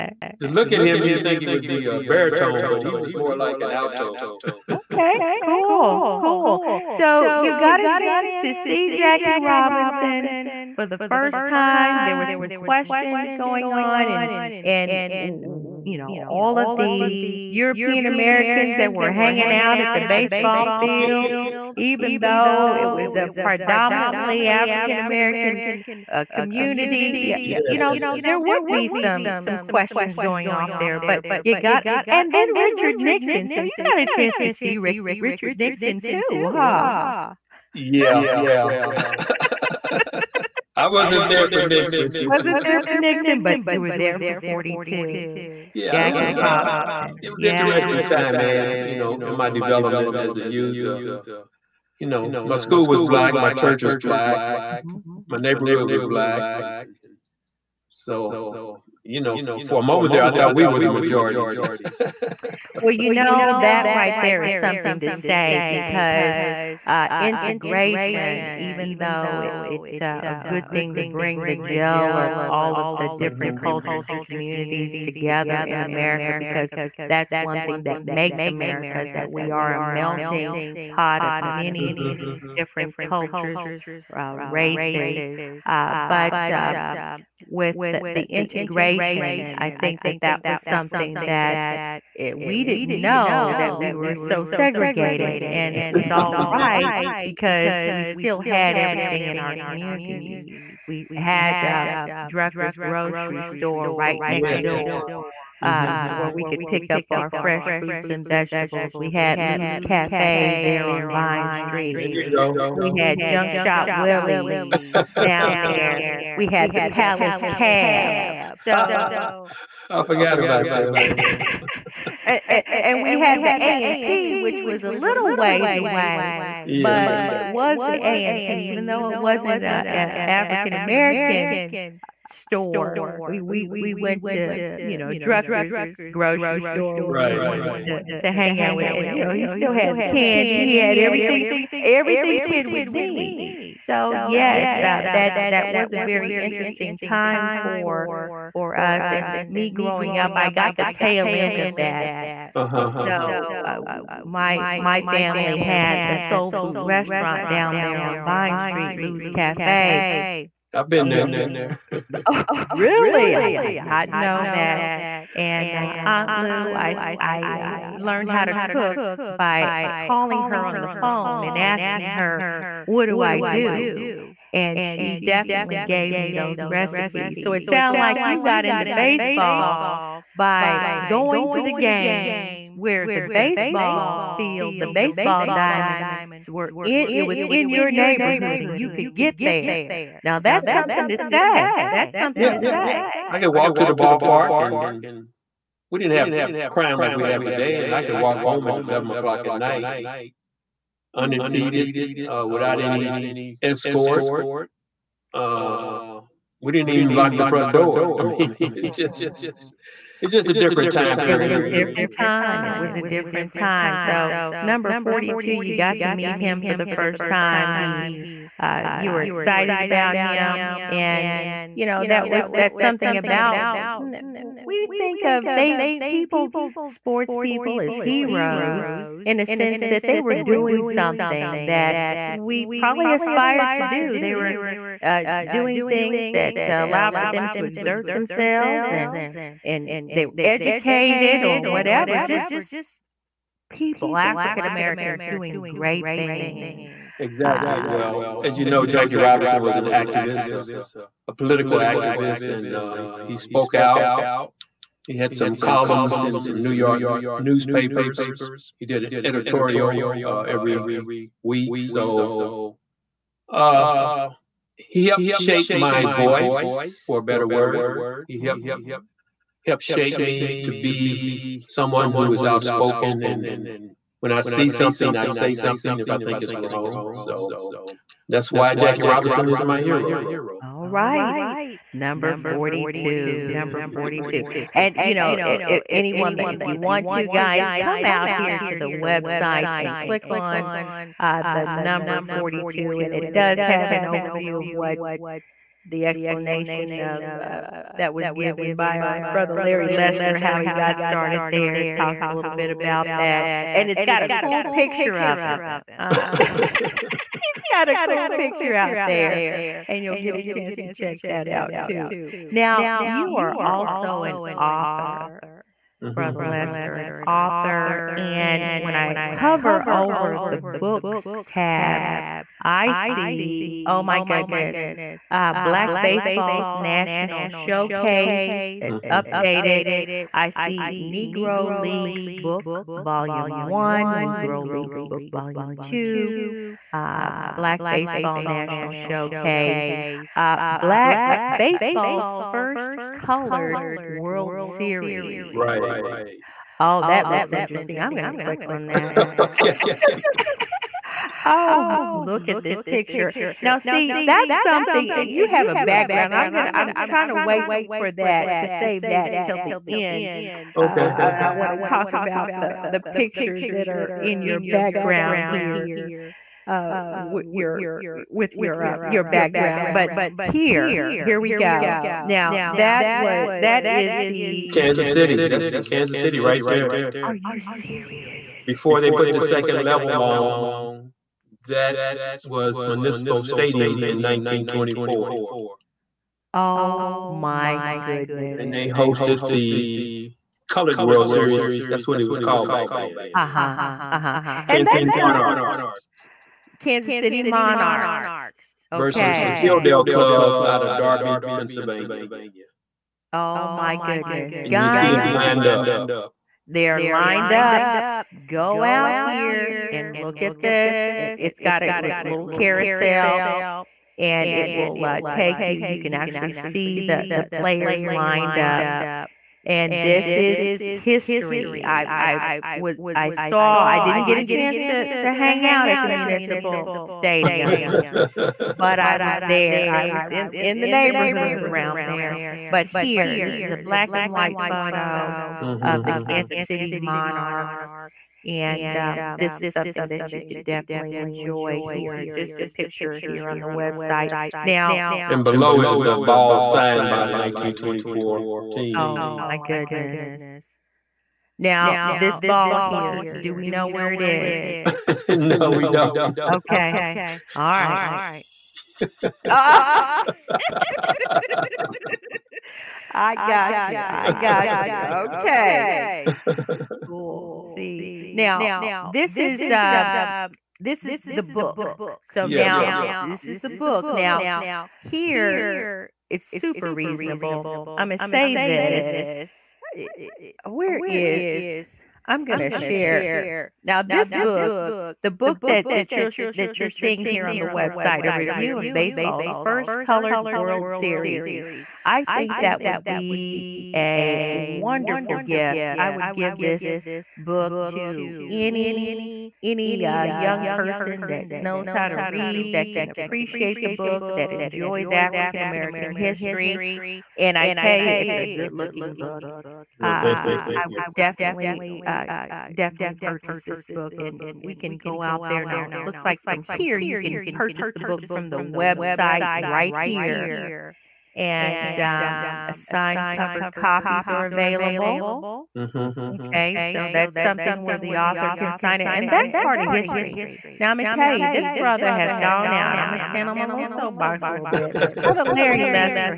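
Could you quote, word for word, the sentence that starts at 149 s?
And me growing up, I got the tail end of that.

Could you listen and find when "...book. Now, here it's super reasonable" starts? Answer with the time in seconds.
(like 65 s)
473 s.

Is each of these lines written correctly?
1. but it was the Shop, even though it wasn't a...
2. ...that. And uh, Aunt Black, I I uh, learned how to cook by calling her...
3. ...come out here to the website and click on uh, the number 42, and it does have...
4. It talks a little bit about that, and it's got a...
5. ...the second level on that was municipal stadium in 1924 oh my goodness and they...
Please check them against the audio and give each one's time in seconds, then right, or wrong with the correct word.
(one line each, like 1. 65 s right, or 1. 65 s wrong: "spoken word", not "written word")
1. 126 s wrong: "AMP", not "Shop"
2. 164 s wrong: "Lou", not "Black"
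3. 287 s right
4. 301 s right
5. 379 s right.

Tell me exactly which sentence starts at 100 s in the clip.
We had uh, Drucker's grocery store right next yes.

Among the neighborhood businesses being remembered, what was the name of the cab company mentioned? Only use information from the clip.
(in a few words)
Palace Cab.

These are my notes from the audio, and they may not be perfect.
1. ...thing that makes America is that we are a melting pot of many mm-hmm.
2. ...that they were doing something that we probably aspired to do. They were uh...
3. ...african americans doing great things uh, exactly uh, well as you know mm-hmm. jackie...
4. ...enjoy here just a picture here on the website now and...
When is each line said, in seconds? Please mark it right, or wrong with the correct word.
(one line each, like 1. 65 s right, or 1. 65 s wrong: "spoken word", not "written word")
1. 77 s right
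2. 229 s right
3. 244 s right
4. 441 s right.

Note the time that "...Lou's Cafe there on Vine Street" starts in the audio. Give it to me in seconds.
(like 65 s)
109 s.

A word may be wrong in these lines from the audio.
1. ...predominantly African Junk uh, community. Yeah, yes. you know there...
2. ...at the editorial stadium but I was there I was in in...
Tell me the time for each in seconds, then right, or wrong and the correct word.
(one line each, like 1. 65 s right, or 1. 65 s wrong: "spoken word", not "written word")
1. 23 s wrong: "American", not "Junk"
2. 425 s wrong: "municipal", not "editorial".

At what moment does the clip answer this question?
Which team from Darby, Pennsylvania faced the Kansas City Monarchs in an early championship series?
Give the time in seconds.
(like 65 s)
399 s.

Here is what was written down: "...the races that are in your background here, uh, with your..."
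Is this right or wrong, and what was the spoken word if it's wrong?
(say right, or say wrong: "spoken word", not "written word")
wrong: "pictures", not "races".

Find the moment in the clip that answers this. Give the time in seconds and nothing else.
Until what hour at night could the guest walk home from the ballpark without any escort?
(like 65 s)
198 s.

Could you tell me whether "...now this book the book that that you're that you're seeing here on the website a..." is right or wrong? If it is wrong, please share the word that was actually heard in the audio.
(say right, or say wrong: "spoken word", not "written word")
right.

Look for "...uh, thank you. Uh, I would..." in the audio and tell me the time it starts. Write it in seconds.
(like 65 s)
510 s.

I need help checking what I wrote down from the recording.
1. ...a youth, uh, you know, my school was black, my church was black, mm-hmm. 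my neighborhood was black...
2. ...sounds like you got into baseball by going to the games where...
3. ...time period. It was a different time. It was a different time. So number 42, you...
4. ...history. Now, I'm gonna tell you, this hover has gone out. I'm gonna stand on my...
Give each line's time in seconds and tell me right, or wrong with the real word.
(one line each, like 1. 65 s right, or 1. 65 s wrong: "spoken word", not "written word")
1. 50 s right
2. 177 s right
3. 210 s right
4. 529 s wrong: "brother", not "hover".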